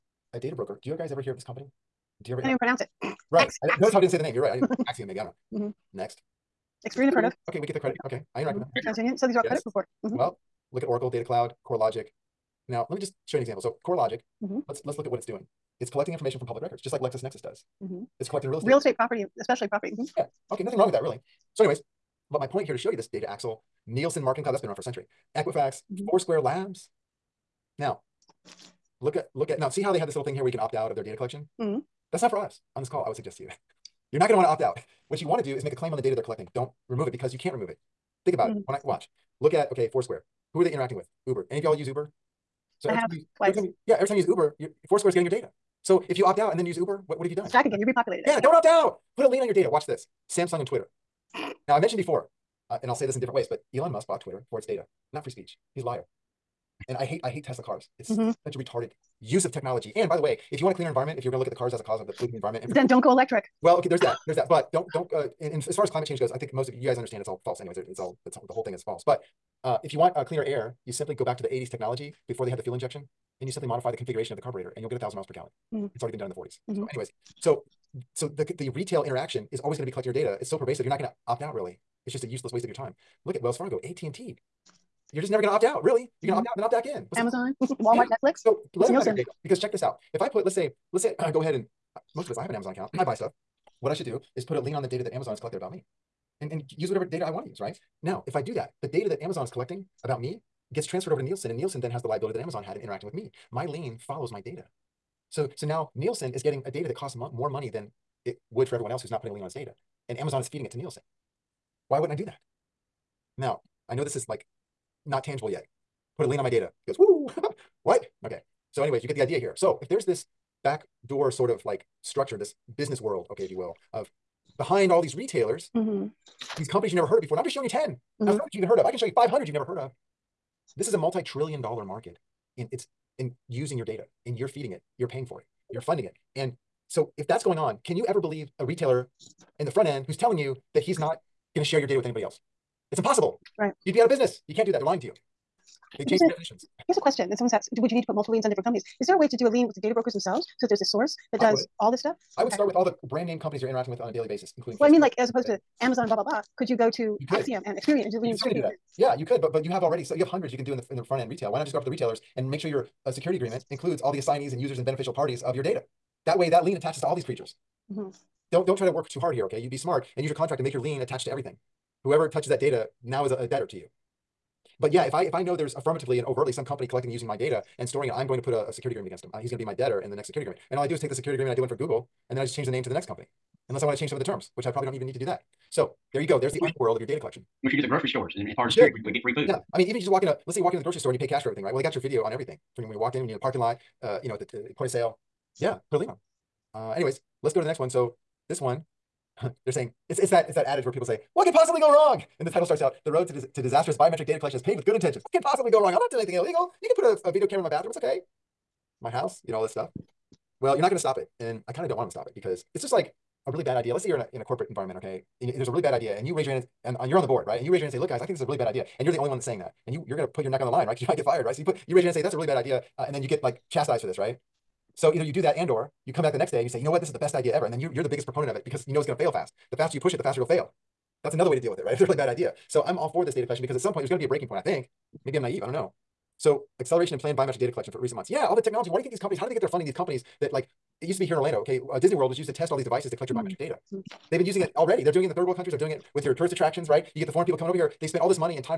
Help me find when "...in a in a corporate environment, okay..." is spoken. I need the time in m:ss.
3:34.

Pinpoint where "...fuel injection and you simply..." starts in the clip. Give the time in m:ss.
1:12.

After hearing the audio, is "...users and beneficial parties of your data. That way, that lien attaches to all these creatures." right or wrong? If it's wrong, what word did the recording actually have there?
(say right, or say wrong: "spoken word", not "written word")
right.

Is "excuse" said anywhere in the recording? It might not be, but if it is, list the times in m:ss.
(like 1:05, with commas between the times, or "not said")
not said.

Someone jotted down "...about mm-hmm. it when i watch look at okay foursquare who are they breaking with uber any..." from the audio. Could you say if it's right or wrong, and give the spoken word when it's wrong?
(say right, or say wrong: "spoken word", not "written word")
wrong: "interacting", not "breaking".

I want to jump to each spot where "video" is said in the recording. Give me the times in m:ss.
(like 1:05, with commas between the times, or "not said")
3:11, 3:27.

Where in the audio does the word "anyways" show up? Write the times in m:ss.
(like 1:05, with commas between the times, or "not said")
0:21, 1:07, 1:16, 1:58, 3:16.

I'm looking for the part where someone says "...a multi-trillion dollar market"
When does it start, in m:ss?
2:10.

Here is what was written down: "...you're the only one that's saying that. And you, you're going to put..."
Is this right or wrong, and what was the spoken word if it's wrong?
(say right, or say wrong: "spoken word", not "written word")
right.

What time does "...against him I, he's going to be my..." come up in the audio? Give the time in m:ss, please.
2:59.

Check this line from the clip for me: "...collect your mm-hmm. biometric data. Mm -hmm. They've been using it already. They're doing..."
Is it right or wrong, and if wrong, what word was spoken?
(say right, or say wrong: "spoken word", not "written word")
right.